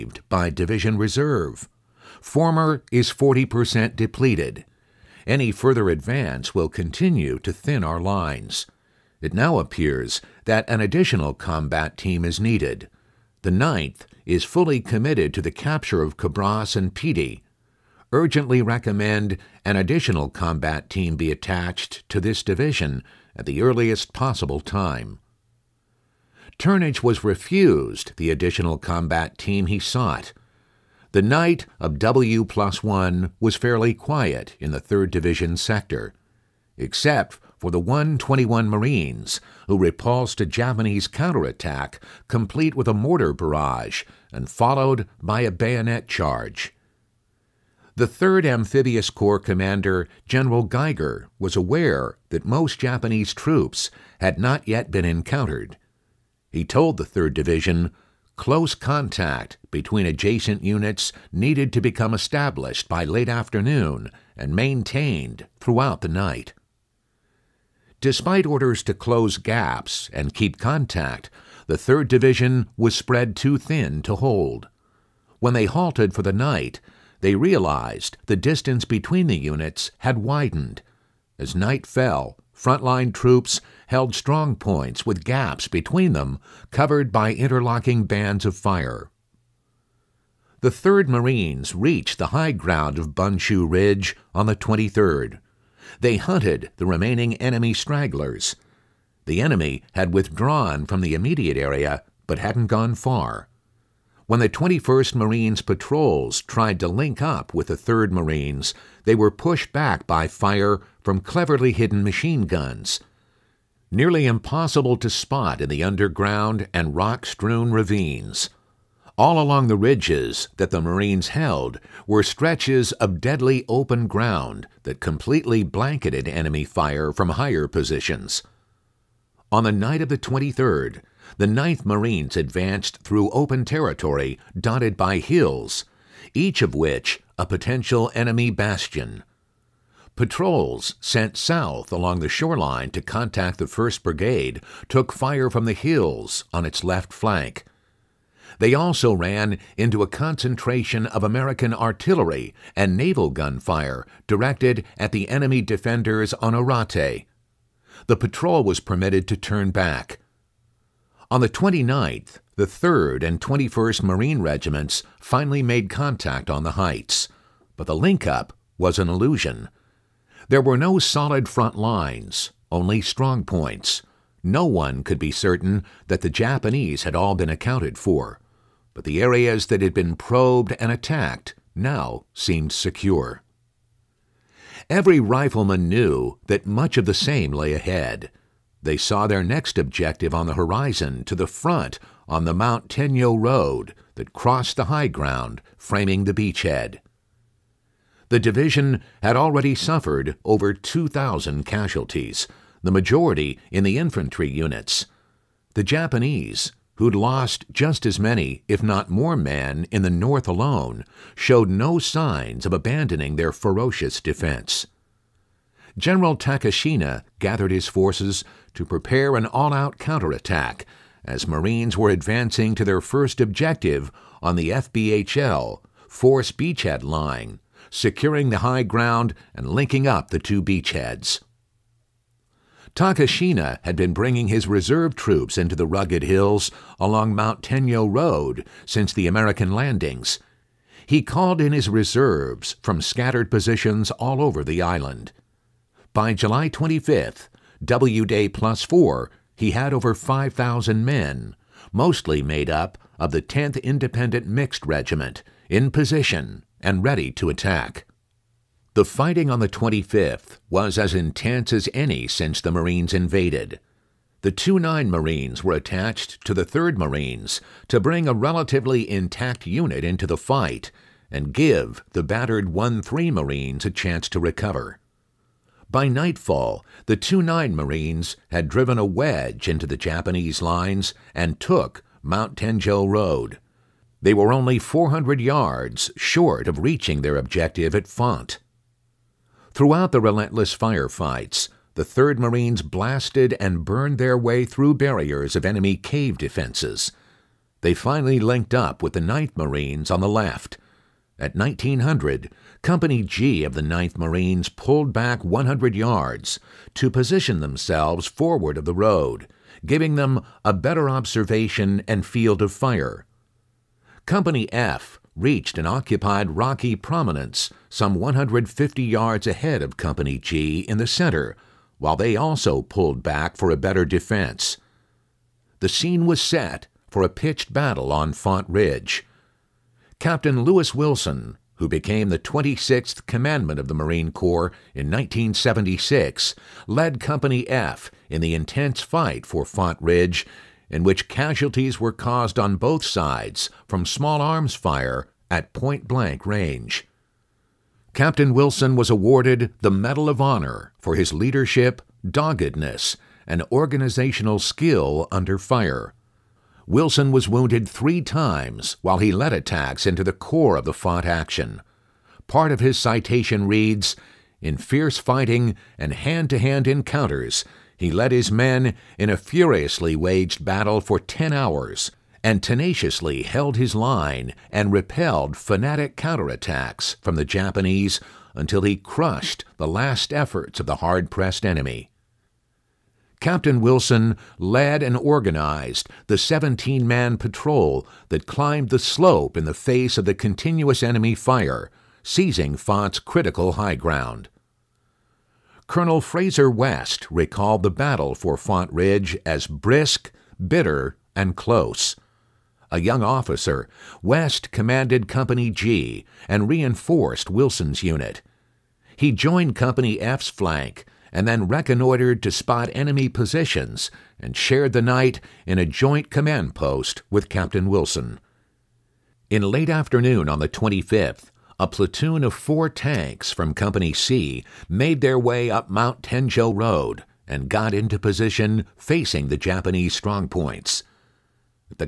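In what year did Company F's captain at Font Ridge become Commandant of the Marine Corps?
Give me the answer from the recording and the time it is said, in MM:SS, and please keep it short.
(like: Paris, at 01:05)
1976, at 05:35.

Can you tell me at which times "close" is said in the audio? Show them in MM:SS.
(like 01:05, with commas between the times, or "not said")
00:58, 01:08, 06:41.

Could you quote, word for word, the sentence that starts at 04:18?
The fighting on the 25th was as intense as any since the Marines invaded.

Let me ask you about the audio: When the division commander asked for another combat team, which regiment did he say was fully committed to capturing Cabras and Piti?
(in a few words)
Ninth.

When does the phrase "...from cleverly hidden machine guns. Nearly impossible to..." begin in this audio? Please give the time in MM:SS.
01:51.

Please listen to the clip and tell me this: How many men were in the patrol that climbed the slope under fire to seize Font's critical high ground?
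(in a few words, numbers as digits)
17.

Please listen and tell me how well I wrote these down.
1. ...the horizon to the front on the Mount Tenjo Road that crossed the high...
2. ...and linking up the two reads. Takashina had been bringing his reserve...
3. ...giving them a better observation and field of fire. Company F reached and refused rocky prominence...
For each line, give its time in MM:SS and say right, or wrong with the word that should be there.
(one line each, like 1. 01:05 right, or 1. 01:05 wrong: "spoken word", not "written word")
1. 03:10 right
2. 03:49 wrong: "beachheads", not "reads"
3. 05:09 wrong: "occupied", not "refused".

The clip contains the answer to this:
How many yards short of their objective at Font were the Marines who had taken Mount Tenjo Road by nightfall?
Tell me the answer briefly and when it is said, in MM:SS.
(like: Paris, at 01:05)
400, at 04:44.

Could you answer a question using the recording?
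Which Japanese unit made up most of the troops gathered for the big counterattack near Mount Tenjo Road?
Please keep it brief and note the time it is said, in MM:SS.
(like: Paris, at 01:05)
10th Independent Mixed Regiment, at 04:13.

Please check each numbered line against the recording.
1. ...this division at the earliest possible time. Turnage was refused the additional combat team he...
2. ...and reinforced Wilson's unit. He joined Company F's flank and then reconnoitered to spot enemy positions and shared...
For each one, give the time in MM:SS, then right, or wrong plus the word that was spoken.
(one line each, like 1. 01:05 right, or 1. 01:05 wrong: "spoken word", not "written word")
1. 00:22 right
2. 06:46 right.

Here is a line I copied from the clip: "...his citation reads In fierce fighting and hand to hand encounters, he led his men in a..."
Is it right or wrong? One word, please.
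right.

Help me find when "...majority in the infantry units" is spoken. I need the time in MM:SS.
03:22.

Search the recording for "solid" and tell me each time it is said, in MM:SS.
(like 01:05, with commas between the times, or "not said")
02:50.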